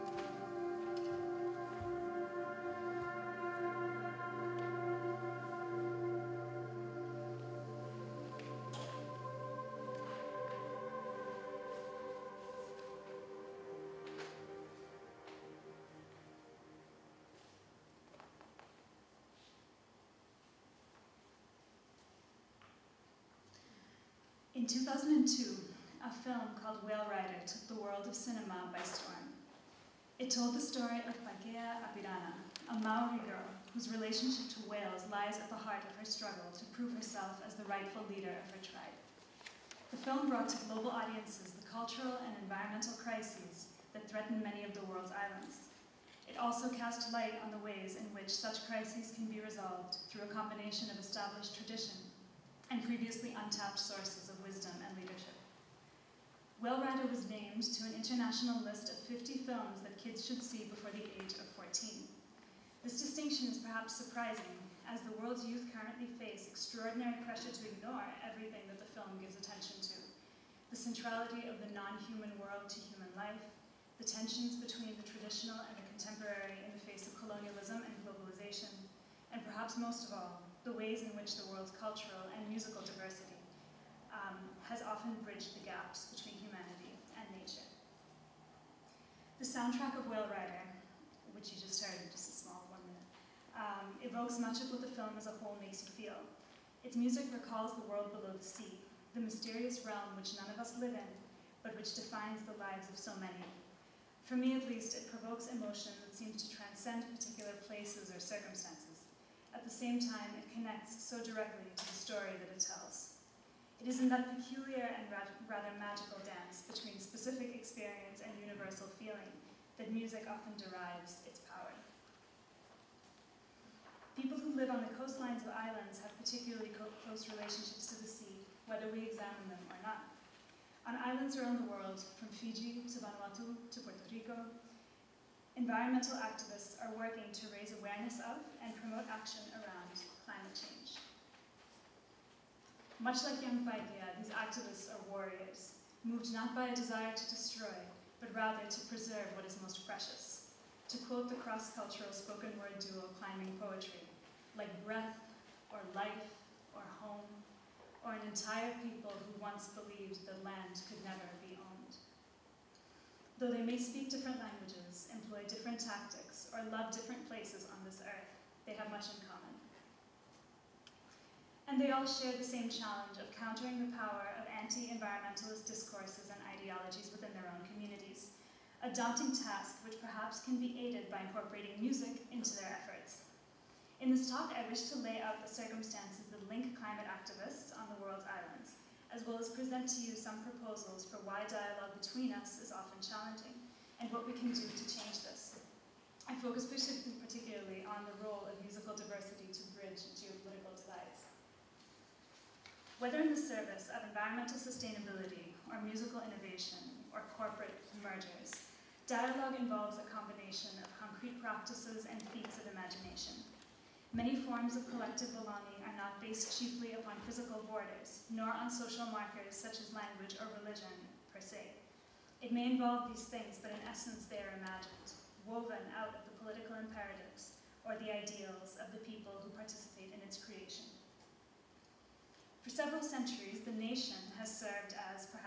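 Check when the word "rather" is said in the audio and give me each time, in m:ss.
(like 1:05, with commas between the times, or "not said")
1:55, 2:28.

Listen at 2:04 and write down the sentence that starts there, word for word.
People who live on the coastlines of islands have particularly close relationships to the sea, whether we examine them or not.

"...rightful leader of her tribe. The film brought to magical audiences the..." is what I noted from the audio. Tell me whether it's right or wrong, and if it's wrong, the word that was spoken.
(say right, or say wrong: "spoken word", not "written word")
wrong: "global", not "magical".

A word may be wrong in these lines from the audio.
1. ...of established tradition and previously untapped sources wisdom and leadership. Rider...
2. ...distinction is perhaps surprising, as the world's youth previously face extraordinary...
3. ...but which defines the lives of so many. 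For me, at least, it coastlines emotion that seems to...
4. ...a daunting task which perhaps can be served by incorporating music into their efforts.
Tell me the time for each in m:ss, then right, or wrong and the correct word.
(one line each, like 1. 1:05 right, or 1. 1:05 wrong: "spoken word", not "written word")
1. 0:50 right
2. 1:03 wrong: "currently", not "previously"
3. 1:41 wrong: "provokes", not "coastlines"
4. 2:58 wrong: "aided", not "served".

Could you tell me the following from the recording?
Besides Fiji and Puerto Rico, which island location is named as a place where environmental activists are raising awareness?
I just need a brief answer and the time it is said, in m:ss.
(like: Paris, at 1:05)
Vanuatu, at 2:13.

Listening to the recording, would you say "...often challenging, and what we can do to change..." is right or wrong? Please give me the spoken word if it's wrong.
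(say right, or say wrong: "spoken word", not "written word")
right.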